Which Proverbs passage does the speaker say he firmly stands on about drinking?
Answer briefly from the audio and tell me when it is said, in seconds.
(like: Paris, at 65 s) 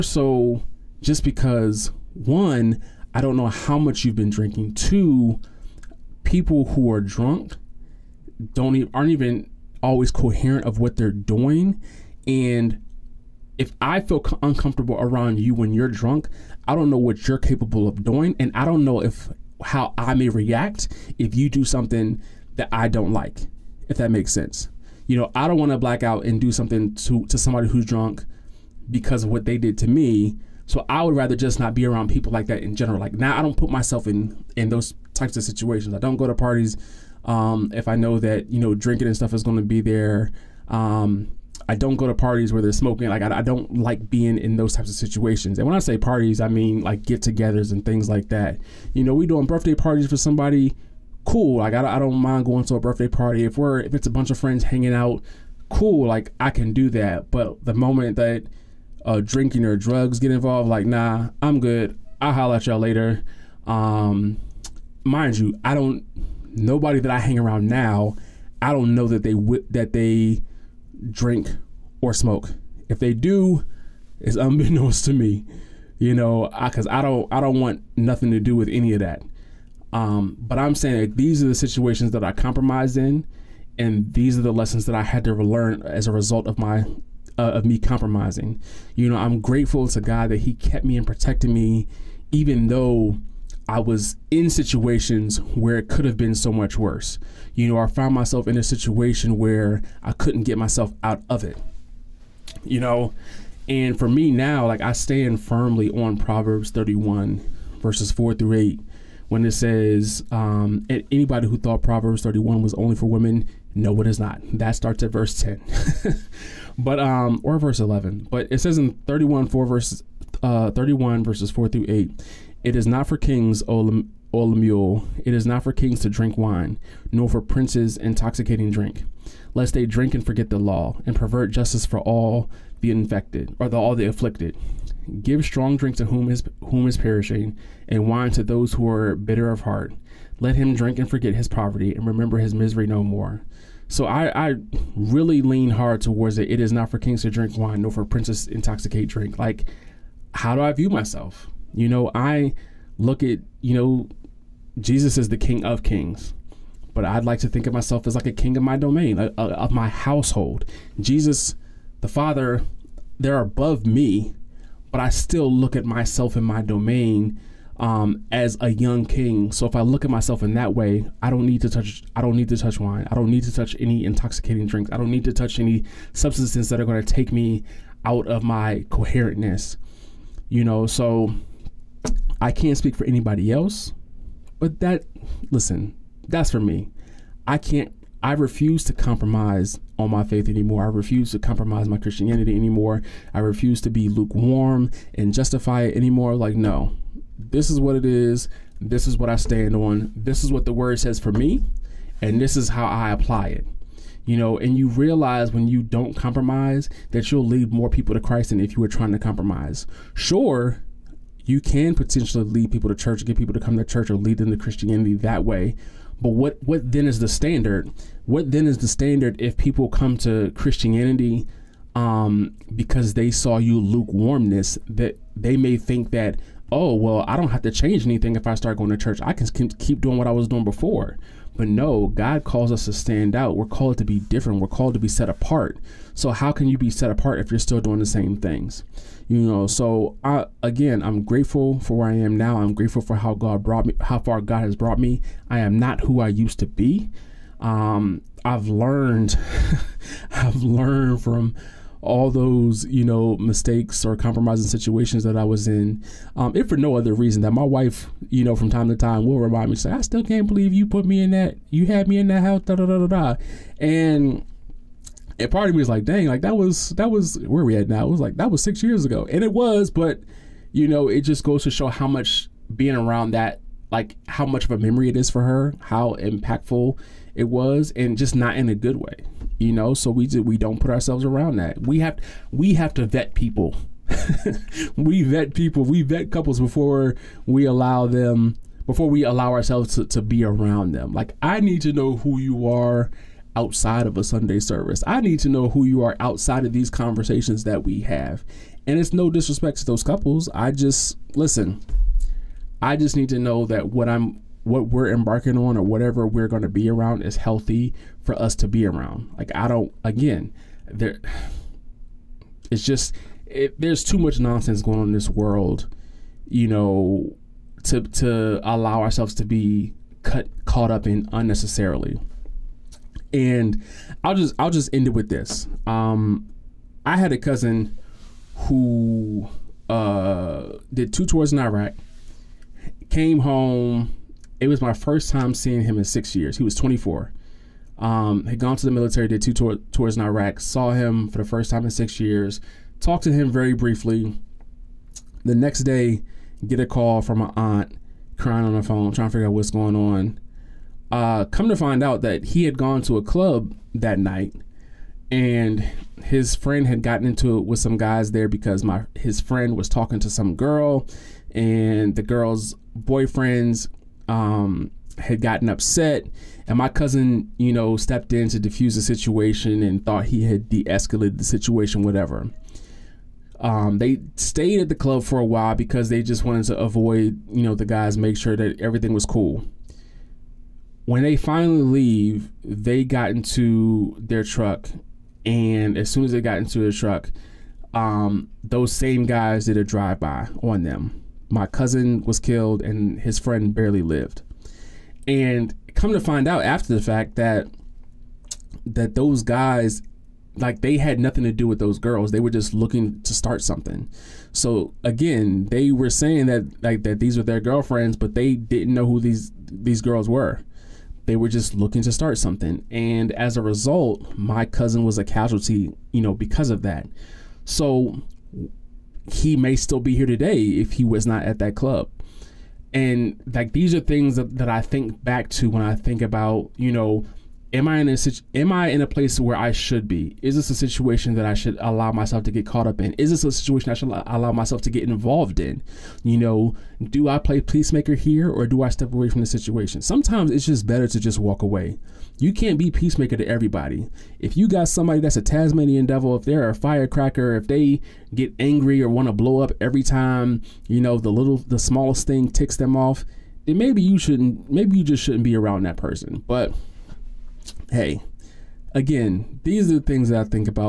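Proverbs 31:4-8, at 106 s.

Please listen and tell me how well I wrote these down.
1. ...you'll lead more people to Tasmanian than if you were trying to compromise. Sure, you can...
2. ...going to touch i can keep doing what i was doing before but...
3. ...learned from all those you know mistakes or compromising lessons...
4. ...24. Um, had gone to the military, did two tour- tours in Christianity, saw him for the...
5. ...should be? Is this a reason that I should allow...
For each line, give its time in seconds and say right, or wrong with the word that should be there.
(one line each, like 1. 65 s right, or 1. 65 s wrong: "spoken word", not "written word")
1. 207 s wrong: "Christ", not "Tasmanian"
2. 228 s wrong: "church", not "touch"
3. 250 s wrong: "situations", not "lessons"
4. 336 s wrong: "Iraq", not "Christianity"
5. 429 s wrong: "situation", not "reason".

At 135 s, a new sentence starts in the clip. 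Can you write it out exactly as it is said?
Give strong drink to whom is whom is perishing, and wine to those who are bitter of heart.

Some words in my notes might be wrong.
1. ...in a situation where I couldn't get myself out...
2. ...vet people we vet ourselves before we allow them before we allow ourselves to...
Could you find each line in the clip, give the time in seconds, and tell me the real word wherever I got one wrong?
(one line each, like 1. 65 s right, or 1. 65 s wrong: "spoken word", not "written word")
1. 98 s right
2. 285 s wrong: "couples", not "ourselves".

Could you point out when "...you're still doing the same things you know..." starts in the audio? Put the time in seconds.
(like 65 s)
237 s.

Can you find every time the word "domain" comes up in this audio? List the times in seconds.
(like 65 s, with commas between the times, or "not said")
158 s, 166 s.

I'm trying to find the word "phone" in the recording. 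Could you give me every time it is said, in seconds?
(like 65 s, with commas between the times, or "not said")
348 s.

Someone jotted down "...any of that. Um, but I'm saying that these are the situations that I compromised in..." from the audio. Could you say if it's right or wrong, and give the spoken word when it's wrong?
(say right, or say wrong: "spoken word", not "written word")
right.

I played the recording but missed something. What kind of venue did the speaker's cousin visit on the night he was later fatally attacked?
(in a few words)
A club.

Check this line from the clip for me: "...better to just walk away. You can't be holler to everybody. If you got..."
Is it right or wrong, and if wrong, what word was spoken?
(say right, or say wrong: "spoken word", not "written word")
wrong: "peacemaker", not "holler".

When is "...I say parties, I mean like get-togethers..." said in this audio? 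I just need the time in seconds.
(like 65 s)
45 s.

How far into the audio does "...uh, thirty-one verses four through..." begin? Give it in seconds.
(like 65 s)
120 s.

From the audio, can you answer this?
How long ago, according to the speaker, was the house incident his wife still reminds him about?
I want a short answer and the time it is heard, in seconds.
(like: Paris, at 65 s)
6 years, at 268 s.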